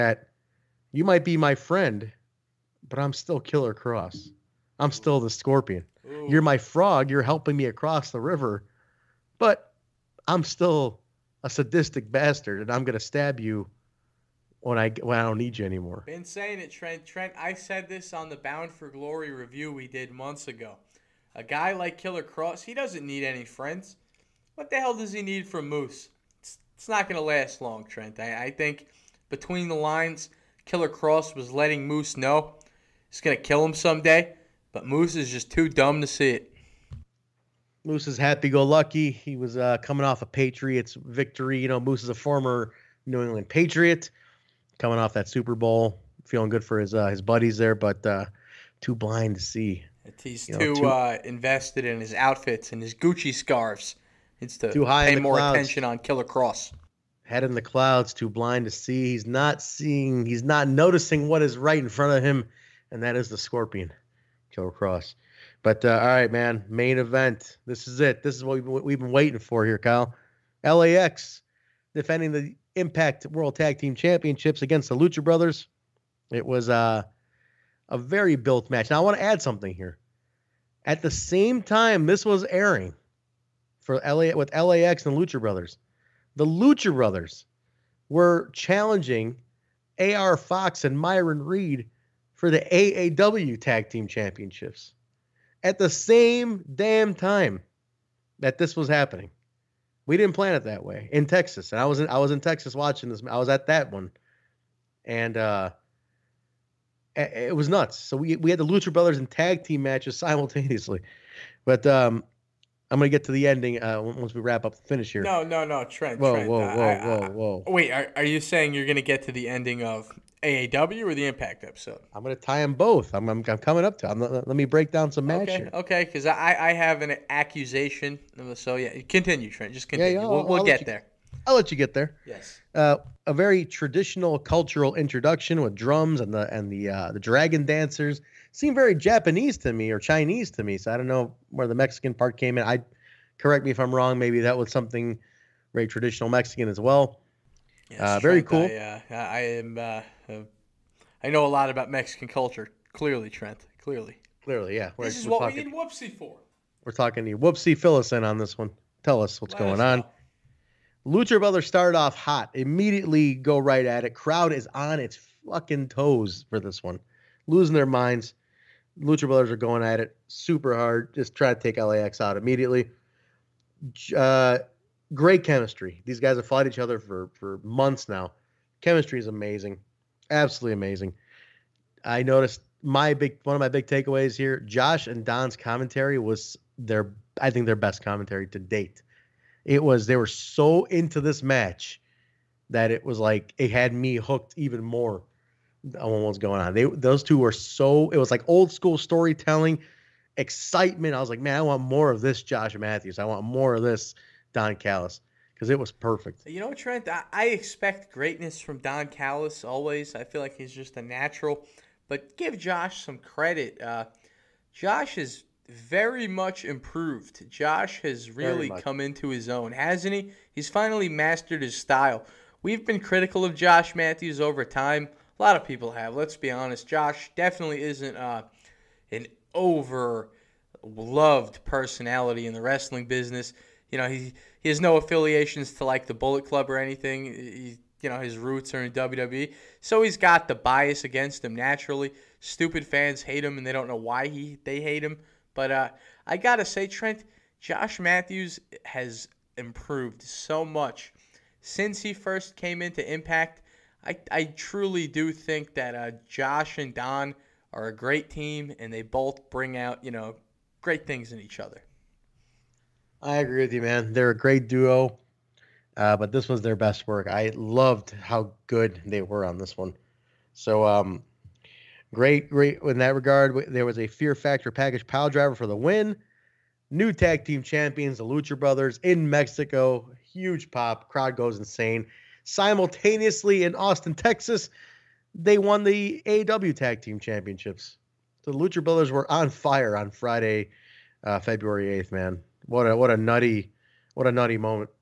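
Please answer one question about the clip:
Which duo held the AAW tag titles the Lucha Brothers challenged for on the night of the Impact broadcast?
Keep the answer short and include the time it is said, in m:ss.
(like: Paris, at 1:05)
AR Fox and Myron Reed, at 1:30.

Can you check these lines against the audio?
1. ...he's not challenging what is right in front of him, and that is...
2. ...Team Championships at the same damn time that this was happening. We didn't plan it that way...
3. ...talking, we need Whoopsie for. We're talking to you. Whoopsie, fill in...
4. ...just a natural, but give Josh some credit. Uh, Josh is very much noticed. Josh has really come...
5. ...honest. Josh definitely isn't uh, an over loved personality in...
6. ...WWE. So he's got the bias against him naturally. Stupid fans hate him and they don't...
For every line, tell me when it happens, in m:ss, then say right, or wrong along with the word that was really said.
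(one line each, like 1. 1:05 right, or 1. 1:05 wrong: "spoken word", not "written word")
1. 1:00 wrong: "noticing", not "challenging"
2. 1:33 right
3. 2:35 right
4. 3:30 wrong: "improved", not "noticed"
5. 3:46 right
6. 3:58 right.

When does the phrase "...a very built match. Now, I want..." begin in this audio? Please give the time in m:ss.
1:17.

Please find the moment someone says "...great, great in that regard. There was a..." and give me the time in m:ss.
4:32.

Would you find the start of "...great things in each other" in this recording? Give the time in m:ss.
4:20.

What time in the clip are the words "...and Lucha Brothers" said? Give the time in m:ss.
1:25.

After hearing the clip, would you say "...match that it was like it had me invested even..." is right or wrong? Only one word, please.
wrong.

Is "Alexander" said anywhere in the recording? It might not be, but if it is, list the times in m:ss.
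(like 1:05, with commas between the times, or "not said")
not said.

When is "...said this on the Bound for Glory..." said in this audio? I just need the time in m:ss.
0:17.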